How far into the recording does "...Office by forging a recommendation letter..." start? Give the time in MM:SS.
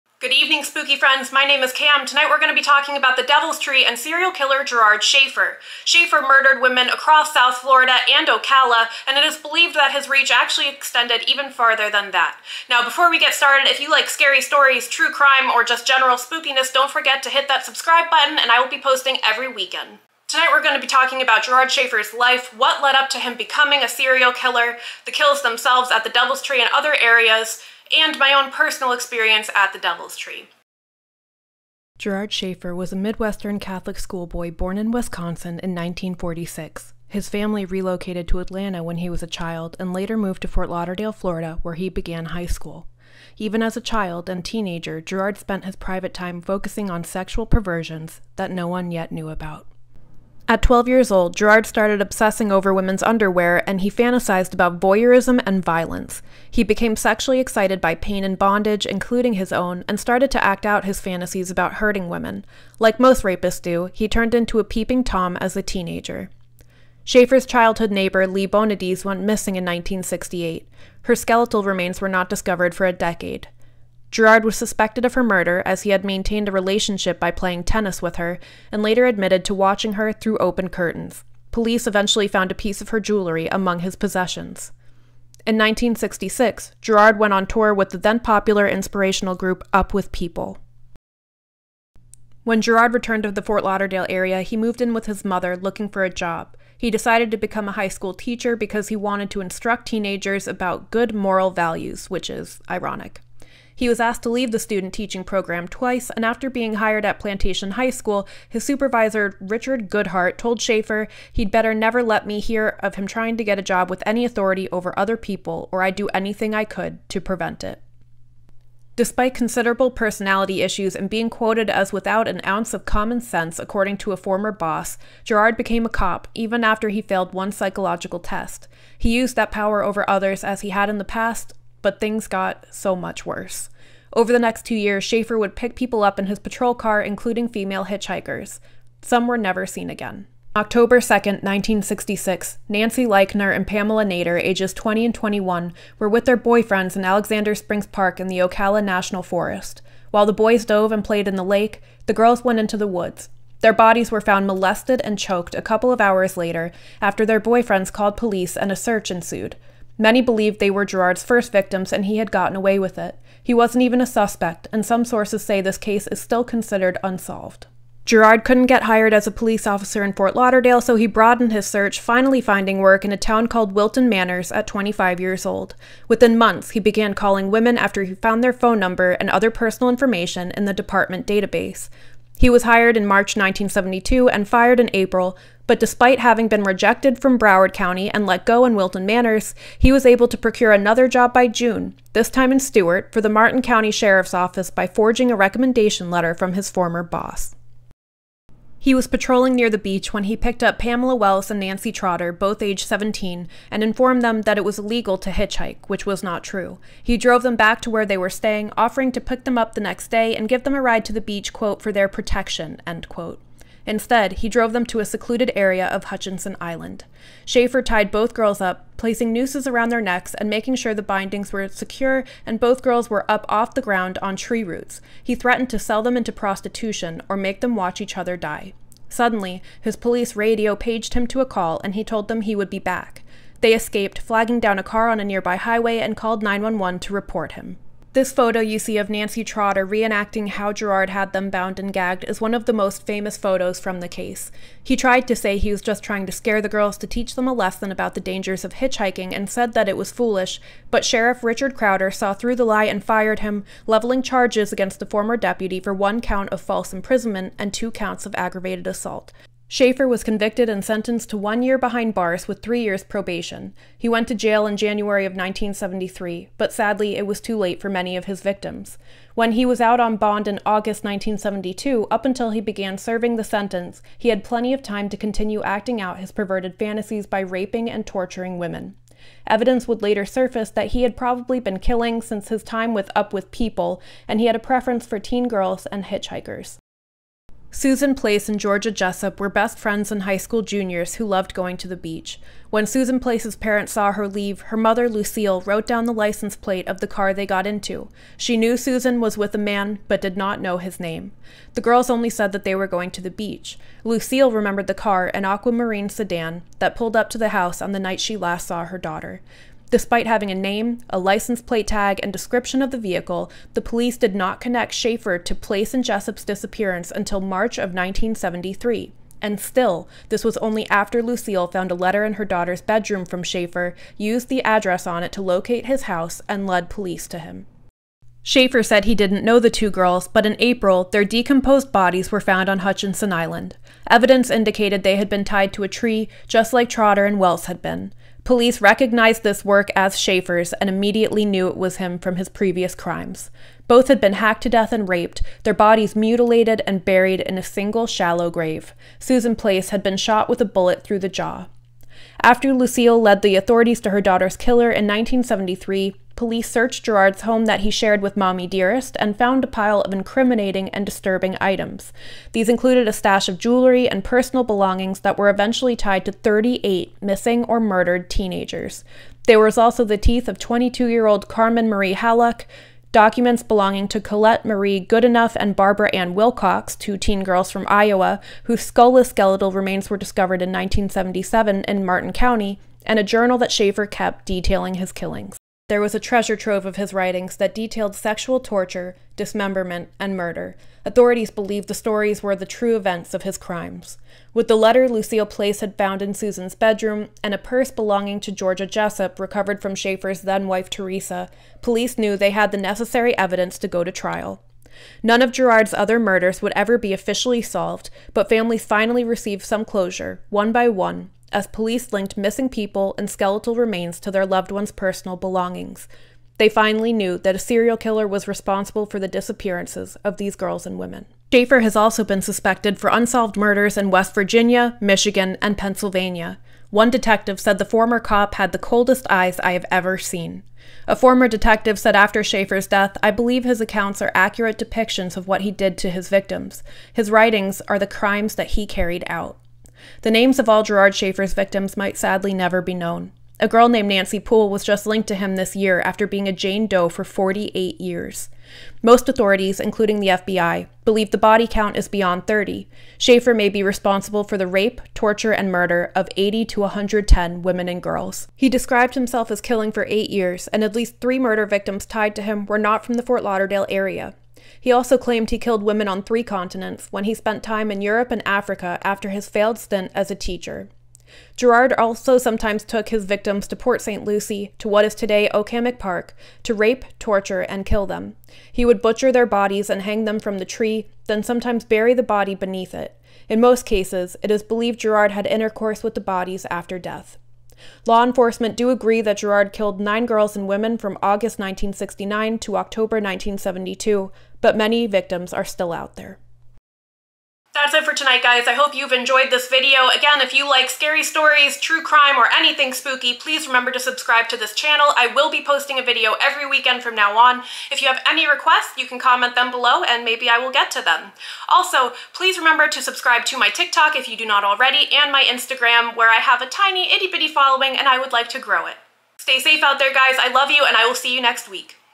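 03:14.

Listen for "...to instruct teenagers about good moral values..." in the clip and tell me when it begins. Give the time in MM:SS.
01:39.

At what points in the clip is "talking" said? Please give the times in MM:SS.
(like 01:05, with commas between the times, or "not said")
00:02, 00:20.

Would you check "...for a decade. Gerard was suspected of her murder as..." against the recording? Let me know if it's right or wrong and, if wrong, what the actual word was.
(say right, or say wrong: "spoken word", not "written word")
right.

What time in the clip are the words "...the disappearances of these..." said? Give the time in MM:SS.
06:59.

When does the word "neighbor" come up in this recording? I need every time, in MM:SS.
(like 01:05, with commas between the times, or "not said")
01:07.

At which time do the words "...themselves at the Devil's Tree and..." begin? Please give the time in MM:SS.
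00:25.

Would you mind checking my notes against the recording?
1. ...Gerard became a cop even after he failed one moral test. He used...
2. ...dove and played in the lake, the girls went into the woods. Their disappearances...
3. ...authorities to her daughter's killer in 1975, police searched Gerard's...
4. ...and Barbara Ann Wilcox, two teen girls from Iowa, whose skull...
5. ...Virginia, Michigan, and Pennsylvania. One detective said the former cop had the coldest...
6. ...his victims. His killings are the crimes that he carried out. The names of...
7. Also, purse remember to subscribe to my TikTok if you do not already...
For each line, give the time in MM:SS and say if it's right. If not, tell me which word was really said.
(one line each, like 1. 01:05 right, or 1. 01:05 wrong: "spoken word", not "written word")
1. 02:05 wrong: "psychological", not "moral"
2. 02:30 wrong: "bodies", not "disappearances"
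3. 05:53 wrong: "1973", not "1975"
4. 06:15 right
5. 07:04 right
6. 07:16 wrong: "writings", not "killings"
7. 08:31 wrong: "please", not "purse".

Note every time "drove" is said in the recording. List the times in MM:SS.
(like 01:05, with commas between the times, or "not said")
03:27, 03:34.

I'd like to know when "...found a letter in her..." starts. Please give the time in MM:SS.
05:21.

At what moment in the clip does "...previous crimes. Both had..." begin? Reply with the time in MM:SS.
05:42.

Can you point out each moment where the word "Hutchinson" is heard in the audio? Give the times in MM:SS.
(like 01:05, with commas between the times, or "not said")
03:36, 05:32.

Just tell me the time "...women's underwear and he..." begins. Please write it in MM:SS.
00:52.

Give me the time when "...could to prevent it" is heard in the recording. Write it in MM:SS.
01:56.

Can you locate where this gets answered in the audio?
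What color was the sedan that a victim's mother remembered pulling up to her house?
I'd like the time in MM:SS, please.
05:05.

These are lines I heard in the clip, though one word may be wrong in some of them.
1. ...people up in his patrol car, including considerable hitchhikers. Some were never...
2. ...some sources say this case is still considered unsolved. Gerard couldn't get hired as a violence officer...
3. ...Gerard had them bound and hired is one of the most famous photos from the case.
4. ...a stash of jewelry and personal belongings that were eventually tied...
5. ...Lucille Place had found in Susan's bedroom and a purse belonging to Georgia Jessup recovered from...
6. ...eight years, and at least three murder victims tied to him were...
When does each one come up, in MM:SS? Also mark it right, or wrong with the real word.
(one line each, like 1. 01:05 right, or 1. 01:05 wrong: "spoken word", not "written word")
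1. 02:15 wrong: "female", not "considerable"
2. 02:44 wrong: "police", not "violence"
3. 04:00 wrong: "gagged", not "hired"
4. 06:03 right
5. 06:35 right
6. 07:40 right.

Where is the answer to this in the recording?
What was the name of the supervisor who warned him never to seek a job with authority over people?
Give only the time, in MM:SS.
01:49.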